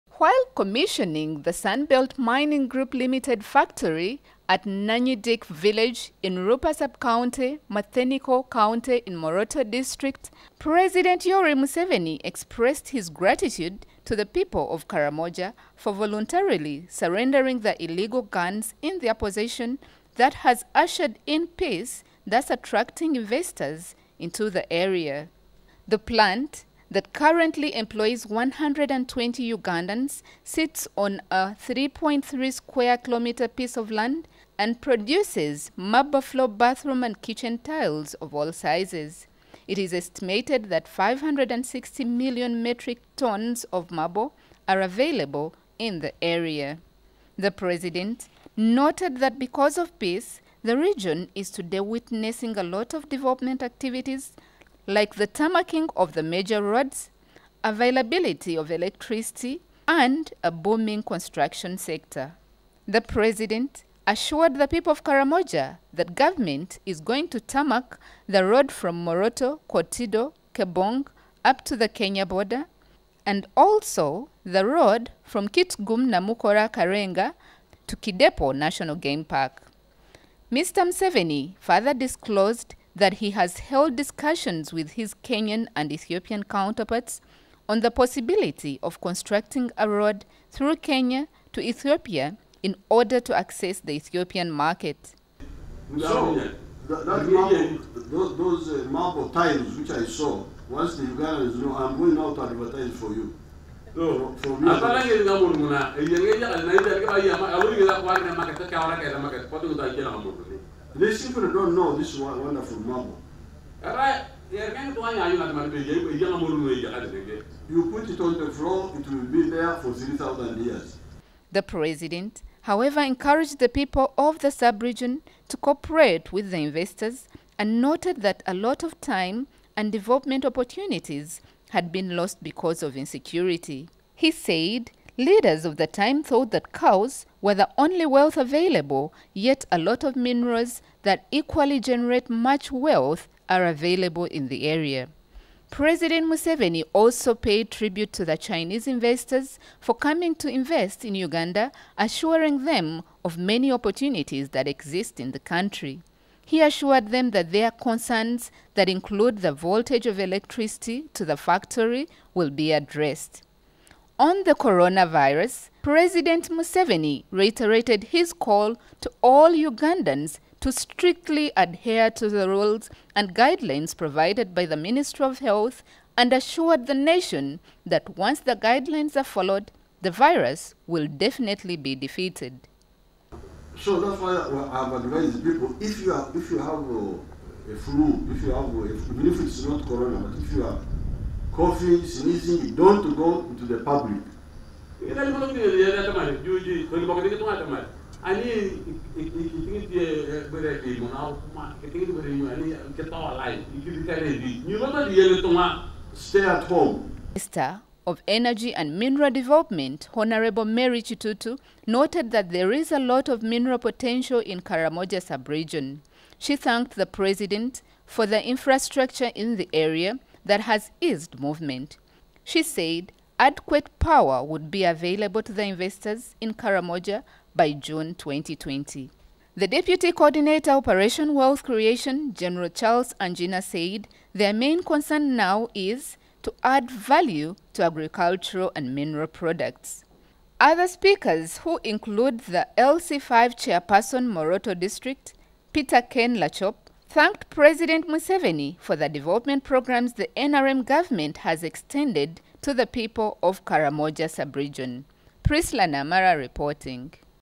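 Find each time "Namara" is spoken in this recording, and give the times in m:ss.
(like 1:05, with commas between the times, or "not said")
4:15.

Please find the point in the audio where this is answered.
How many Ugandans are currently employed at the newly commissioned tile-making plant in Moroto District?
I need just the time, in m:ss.
0:28.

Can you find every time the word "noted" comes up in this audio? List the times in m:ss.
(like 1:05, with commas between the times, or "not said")
0:48, 2:07, 3:31.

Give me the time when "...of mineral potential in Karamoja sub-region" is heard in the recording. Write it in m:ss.
3:33.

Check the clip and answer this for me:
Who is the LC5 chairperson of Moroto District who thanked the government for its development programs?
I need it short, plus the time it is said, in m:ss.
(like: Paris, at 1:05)
Peter Ken Lachop, at 4:05.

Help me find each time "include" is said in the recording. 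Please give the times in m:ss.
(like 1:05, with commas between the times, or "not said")
2:38, 4:01.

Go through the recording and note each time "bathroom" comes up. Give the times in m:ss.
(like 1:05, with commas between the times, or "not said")
0:36.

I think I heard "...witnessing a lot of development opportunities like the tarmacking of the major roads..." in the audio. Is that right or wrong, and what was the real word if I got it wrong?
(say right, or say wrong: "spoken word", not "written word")
wrong: "activities", not "opportunities".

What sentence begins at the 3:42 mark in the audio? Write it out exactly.
She said adequate power would be available to the investors in Karamoja by June 2020.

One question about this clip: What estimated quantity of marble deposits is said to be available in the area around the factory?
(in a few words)
560 million metric tons.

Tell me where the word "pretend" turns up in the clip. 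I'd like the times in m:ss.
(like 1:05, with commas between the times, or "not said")
not said.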